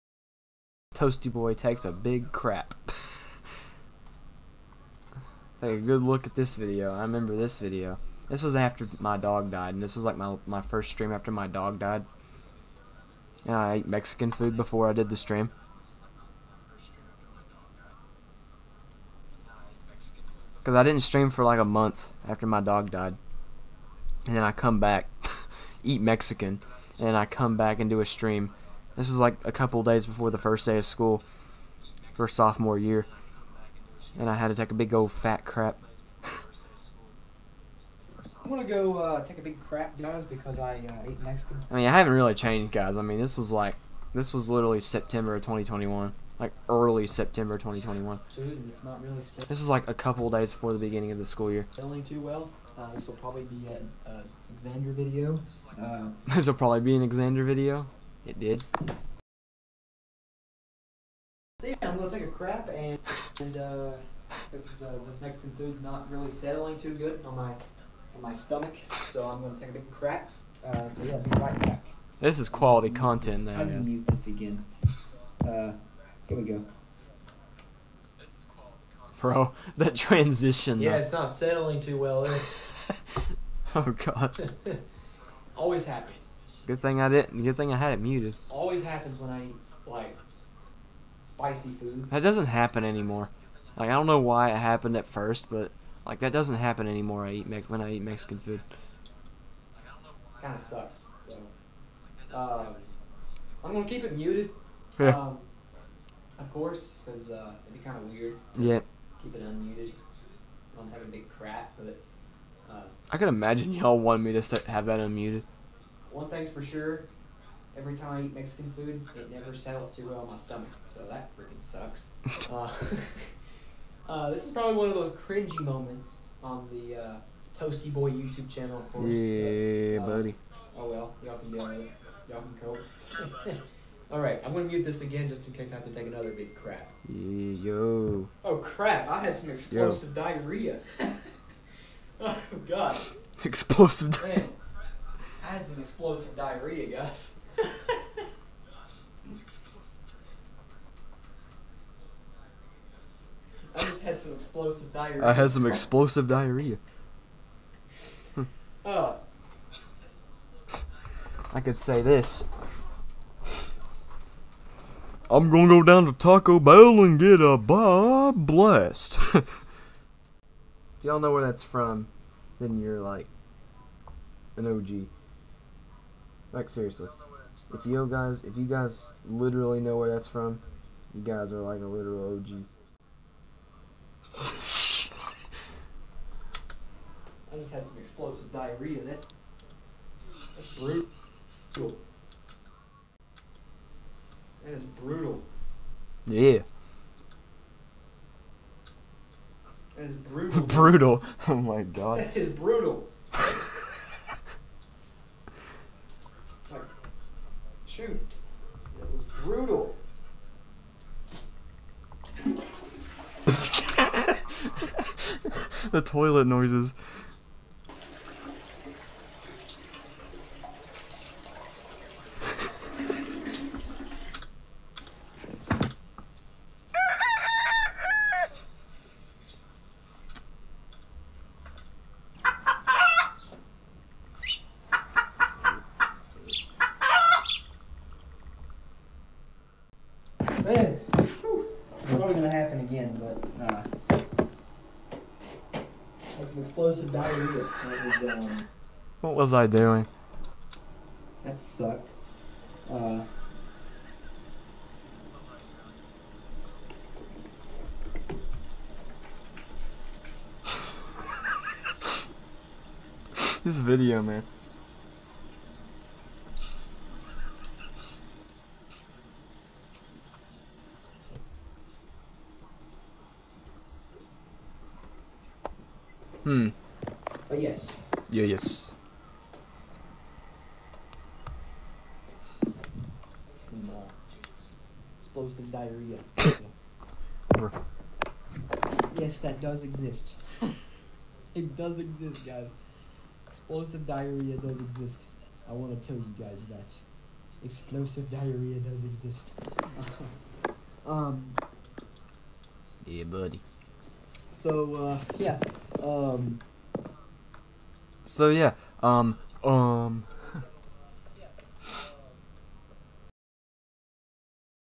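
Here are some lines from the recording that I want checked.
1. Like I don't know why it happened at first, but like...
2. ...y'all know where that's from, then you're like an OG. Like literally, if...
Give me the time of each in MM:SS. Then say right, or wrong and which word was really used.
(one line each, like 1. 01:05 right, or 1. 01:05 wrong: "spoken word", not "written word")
1. 01:33 right
2. 02:51 wrong: "seriously", not "literally".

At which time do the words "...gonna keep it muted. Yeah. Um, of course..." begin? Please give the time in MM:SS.
01:43.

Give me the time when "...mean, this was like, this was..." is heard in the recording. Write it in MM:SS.
00:43.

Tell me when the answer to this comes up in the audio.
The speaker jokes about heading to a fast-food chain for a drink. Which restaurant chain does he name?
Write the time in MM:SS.
02:46.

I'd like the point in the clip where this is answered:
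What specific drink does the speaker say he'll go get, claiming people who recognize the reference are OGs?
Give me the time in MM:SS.
02:47.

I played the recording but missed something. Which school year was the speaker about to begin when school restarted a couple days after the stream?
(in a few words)
Sophomore year.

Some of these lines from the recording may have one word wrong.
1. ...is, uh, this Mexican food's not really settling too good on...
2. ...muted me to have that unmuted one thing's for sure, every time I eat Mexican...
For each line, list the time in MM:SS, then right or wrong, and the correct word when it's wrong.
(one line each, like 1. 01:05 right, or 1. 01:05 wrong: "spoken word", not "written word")
1. 01:04 right
2. 01:53 wrong: "wanted", not "muted".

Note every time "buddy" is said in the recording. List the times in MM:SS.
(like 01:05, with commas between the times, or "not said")
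02:10, 05:03.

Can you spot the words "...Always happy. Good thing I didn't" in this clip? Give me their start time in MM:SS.
01:25.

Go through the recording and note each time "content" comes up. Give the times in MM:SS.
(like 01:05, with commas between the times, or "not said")
01:12.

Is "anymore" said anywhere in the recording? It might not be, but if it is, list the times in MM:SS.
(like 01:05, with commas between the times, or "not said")
01:32, 01:36.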